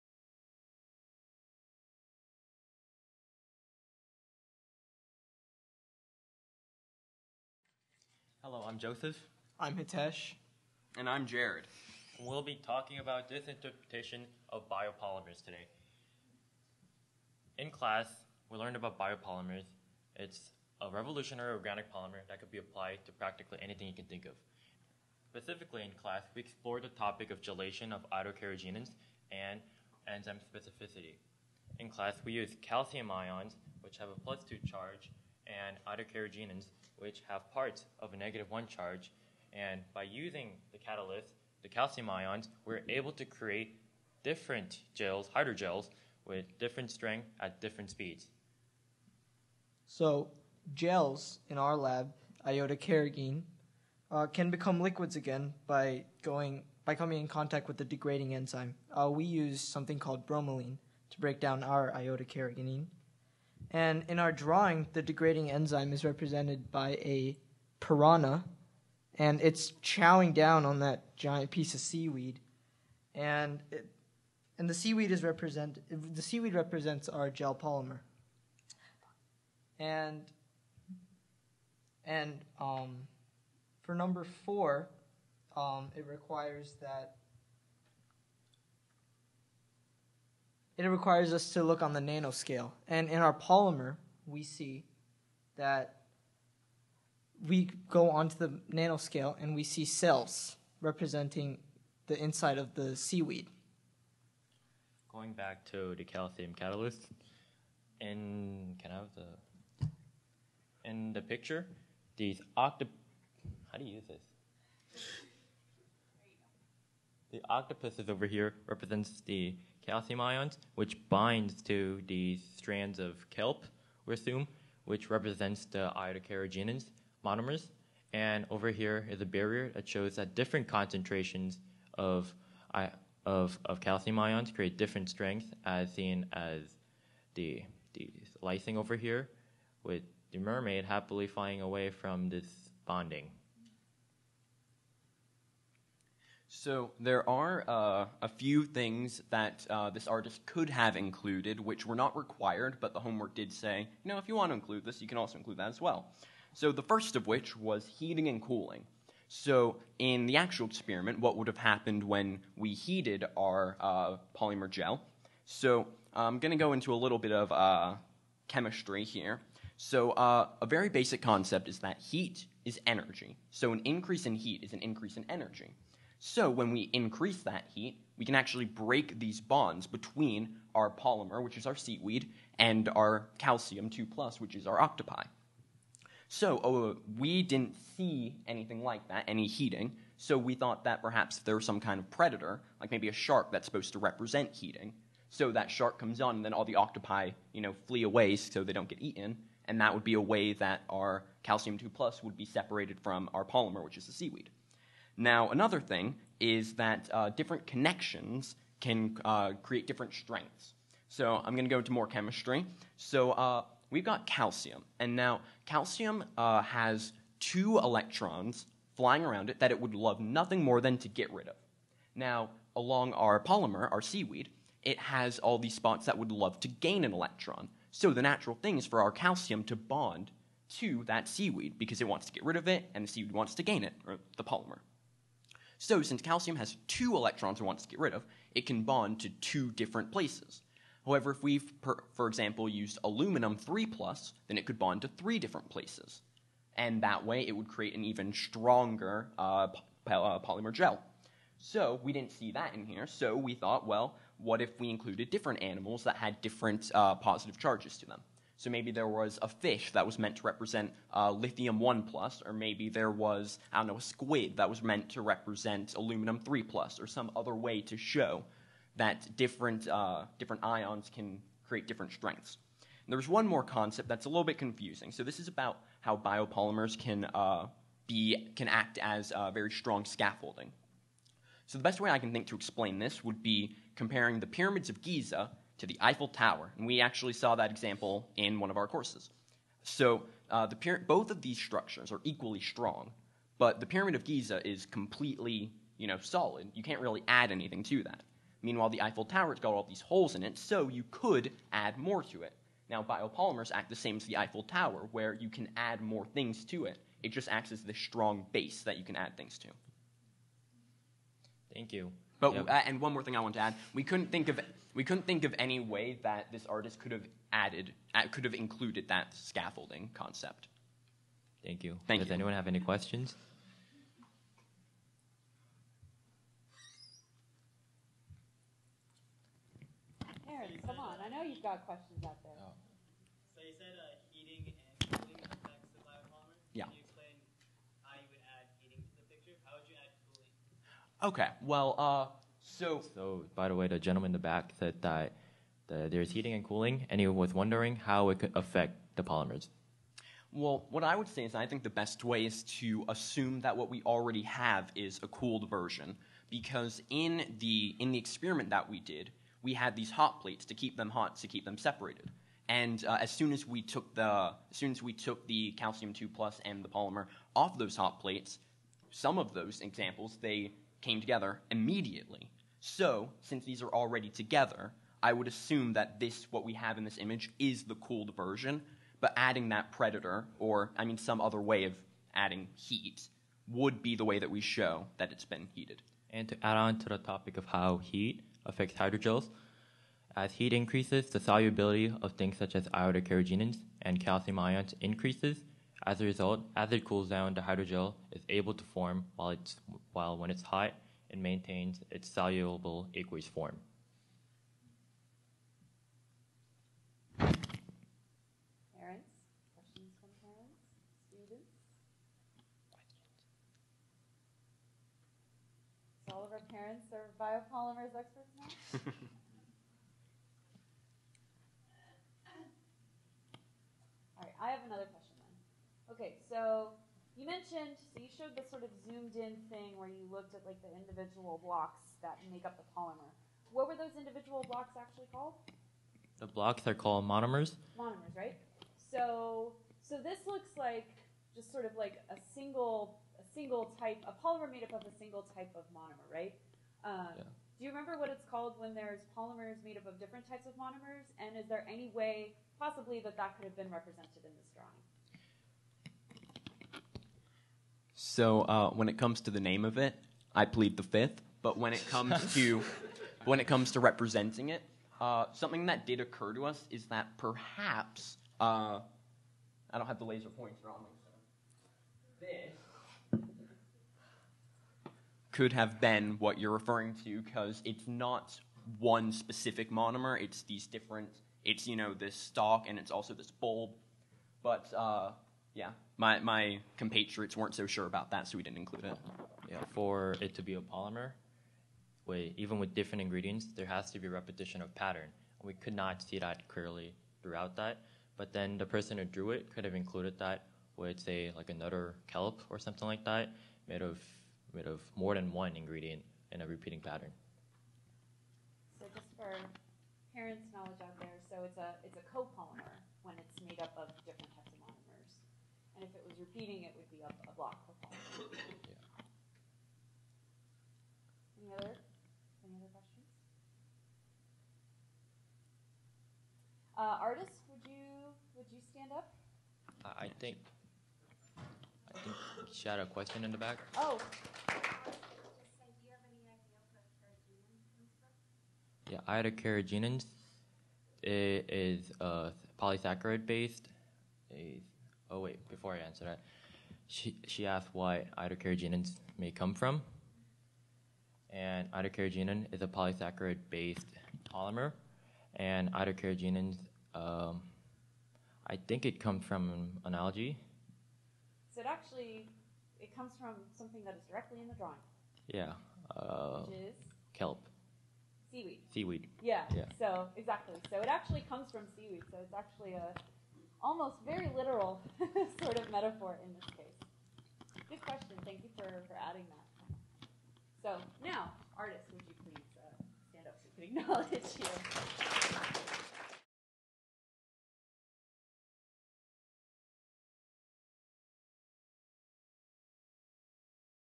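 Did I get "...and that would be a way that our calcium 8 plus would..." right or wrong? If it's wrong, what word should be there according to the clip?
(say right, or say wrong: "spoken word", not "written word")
wrong: "2", not "8".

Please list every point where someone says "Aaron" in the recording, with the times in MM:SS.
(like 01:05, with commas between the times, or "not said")
05:30.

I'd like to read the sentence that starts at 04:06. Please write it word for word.
And that way it would create an even stronger uh, uh, polymer gel.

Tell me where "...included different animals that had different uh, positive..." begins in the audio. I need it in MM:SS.
04:14.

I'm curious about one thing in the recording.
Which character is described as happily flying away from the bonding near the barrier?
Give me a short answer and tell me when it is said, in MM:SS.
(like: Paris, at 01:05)
mermaid, at 02:20.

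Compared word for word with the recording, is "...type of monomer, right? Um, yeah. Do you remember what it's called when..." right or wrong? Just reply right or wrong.
right.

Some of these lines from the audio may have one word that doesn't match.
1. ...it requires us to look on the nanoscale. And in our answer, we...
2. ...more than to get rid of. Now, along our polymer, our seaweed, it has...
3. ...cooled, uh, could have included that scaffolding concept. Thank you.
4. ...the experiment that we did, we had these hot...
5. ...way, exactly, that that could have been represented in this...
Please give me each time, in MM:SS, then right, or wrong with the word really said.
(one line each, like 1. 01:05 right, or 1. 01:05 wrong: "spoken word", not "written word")
1. 01:30 wrong: "polymer", not "answer"
2. 03:40 right
3. 05:17 wrong: "added", not "cooled"
4. 05:58 right
5. 07:32 wrong: "possibly", not "exactly".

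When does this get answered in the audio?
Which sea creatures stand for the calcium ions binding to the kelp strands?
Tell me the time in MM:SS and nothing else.
01:57.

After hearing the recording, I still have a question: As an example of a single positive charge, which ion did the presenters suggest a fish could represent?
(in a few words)
lithium 1 plus.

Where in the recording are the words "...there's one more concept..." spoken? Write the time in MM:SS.
04:33.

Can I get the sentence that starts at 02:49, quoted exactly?
So uh, a very basic concept is that heat is energy.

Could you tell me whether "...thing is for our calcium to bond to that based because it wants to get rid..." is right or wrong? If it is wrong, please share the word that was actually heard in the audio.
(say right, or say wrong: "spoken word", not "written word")
wrong: "seaweed", not "based".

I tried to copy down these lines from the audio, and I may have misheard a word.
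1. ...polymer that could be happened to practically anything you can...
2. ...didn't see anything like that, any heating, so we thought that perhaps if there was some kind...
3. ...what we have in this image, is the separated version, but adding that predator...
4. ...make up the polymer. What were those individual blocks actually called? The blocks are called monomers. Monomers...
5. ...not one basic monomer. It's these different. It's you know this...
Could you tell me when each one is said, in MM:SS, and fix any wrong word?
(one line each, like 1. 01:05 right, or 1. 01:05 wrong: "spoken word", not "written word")
1. 00:21 wrong: "applied", not "happened"
2. 03:07 right
3. 06:16 wrong: "cooled", not "separated"
4. 07:12 right
5. 07:58 wrong: "specific", not "basic".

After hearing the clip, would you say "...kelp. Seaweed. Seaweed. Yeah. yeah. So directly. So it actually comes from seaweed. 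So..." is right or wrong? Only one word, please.
wrong.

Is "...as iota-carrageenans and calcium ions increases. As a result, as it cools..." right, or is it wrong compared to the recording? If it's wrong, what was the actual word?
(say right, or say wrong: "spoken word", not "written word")
right.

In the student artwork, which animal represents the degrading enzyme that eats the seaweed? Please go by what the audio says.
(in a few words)
piranha.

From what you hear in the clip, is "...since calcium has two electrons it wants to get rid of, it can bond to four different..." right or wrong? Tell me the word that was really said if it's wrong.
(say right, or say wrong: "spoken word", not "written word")
wrong: "two", not "four".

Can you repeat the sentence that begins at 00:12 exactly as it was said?
We'll be talking about this interpretation of biopolymers today.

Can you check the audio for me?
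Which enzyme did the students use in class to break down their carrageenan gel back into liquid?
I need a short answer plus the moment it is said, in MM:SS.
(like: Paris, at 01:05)
bromelain, at 01:00.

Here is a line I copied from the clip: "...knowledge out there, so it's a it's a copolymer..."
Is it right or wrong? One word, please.
right.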